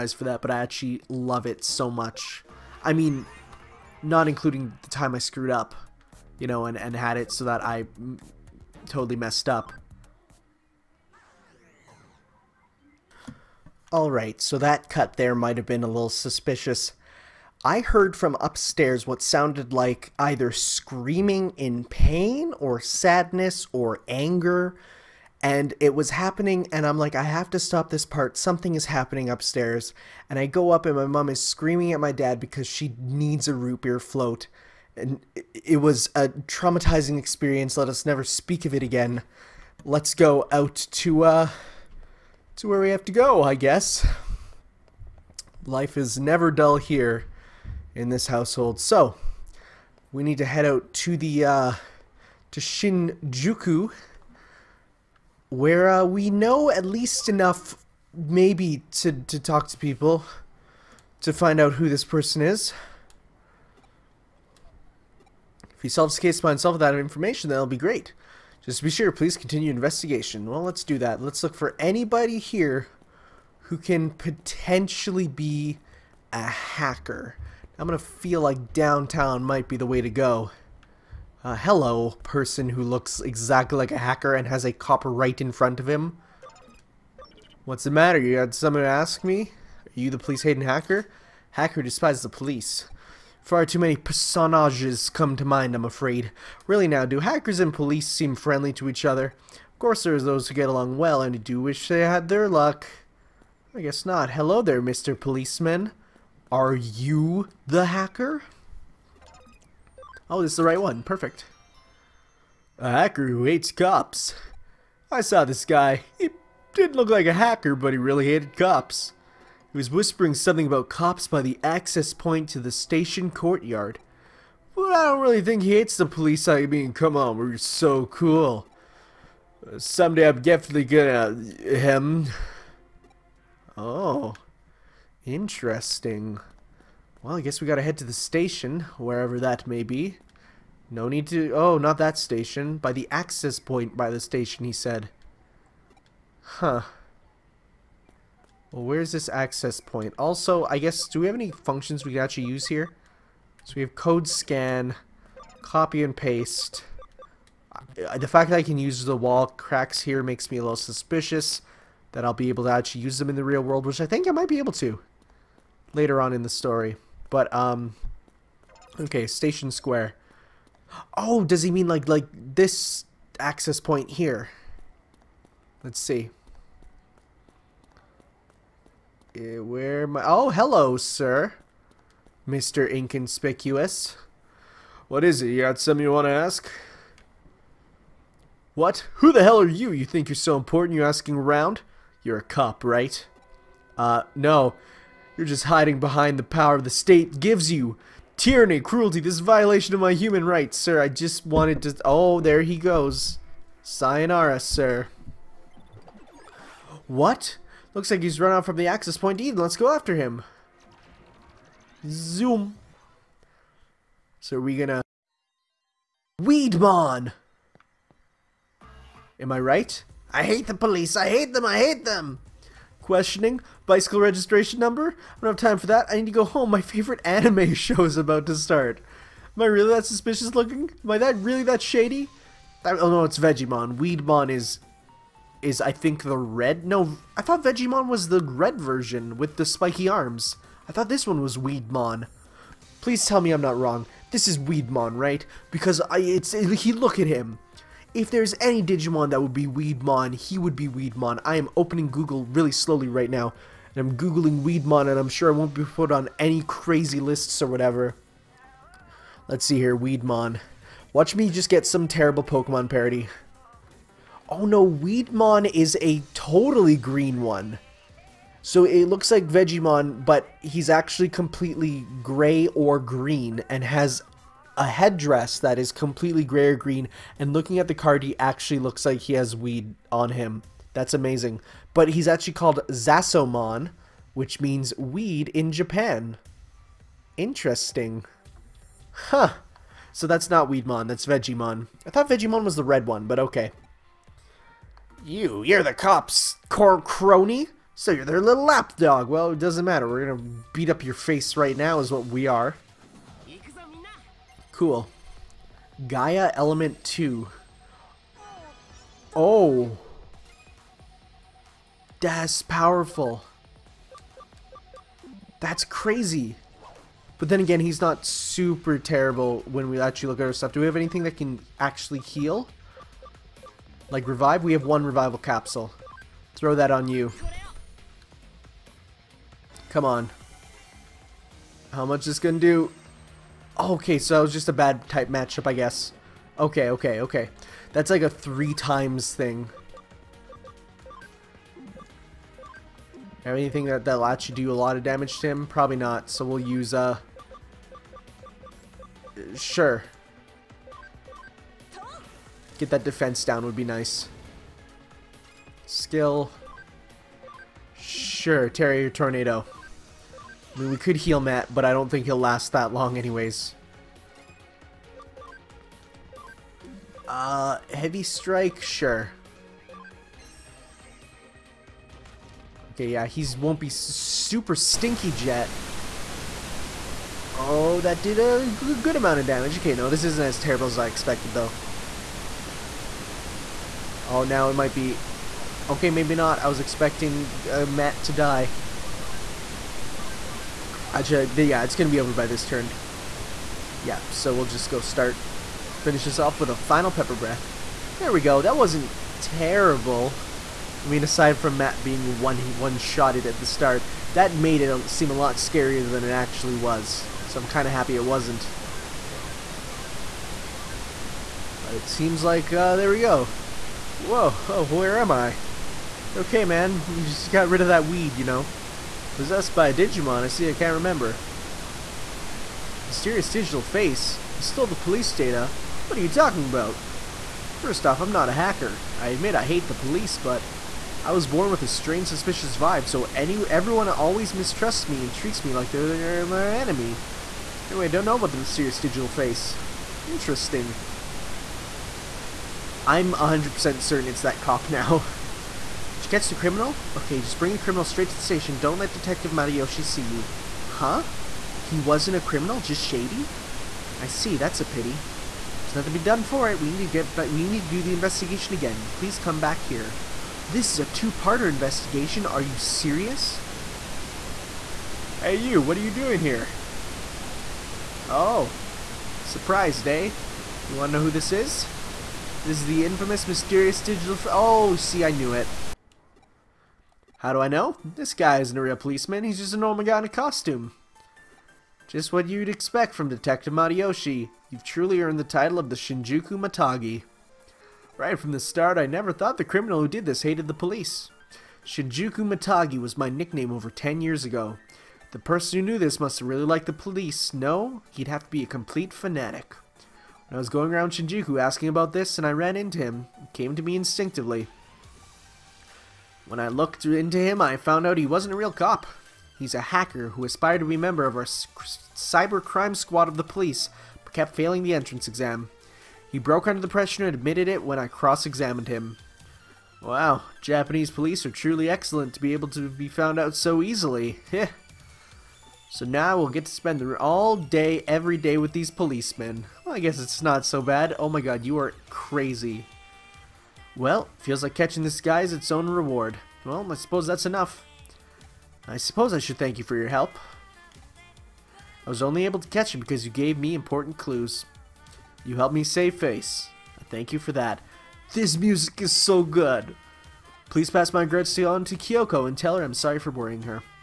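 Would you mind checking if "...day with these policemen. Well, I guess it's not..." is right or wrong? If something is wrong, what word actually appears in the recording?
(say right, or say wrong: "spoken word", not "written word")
right.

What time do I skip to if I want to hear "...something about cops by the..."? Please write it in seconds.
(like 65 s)
120 s.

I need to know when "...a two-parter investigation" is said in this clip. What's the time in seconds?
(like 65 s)
460 s.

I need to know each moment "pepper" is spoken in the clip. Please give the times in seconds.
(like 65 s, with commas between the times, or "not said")
397 s.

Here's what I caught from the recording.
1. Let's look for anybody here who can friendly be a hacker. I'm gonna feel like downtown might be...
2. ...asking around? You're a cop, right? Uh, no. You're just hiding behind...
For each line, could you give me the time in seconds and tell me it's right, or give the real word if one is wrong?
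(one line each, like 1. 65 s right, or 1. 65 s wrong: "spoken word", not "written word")
1. 71 s wrong: "potentially", not "friendly"
2. 191 s right.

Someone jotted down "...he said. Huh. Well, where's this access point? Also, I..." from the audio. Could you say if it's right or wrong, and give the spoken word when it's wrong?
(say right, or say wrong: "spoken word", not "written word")
right.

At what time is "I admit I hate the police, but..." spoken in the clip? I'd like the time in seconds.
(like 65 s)
429 s.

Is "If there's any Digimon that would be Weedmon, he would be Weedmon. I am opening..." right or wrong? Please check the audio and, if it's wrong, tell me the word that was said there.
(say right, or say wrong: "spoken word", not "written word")
right.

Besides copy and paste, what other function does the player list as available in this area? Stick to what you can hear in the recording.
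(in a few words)
Code scan.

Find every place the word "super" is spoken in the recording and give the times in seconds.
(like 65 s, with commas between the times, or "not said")
318 s, 373 s.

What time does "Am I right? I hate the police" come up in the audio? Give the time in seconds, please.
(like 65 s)
219 s.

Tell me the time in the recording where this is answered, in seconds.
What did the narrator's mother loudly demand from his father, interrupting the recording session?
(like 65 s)
33 s.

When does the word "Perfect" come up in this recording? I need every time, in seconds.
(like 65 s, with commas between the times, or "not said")
111 s.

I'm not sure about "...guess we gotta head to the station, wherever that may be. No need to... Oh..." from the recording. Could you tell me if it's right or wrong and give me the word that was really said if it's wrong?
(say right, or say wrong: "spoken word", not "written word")
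right.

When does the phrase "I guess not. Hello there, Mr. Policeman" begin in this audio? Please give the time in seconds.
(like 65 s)
103 s.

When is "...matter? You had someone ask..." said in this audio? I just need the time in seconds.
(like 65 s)
87 s.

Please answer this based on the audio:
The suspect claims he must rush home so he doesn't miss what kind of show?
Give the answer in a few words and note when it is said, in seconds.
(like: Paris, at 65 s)
Anime, at 227 s.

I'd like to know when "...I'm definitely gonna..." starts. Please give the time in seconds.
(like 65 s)
130 s.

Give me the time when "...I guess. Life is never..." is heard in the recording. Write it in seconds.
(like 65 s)
43 s.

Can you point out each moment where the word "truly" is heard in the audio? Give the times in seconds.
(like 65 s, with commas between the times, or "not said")
484 s, 521 s.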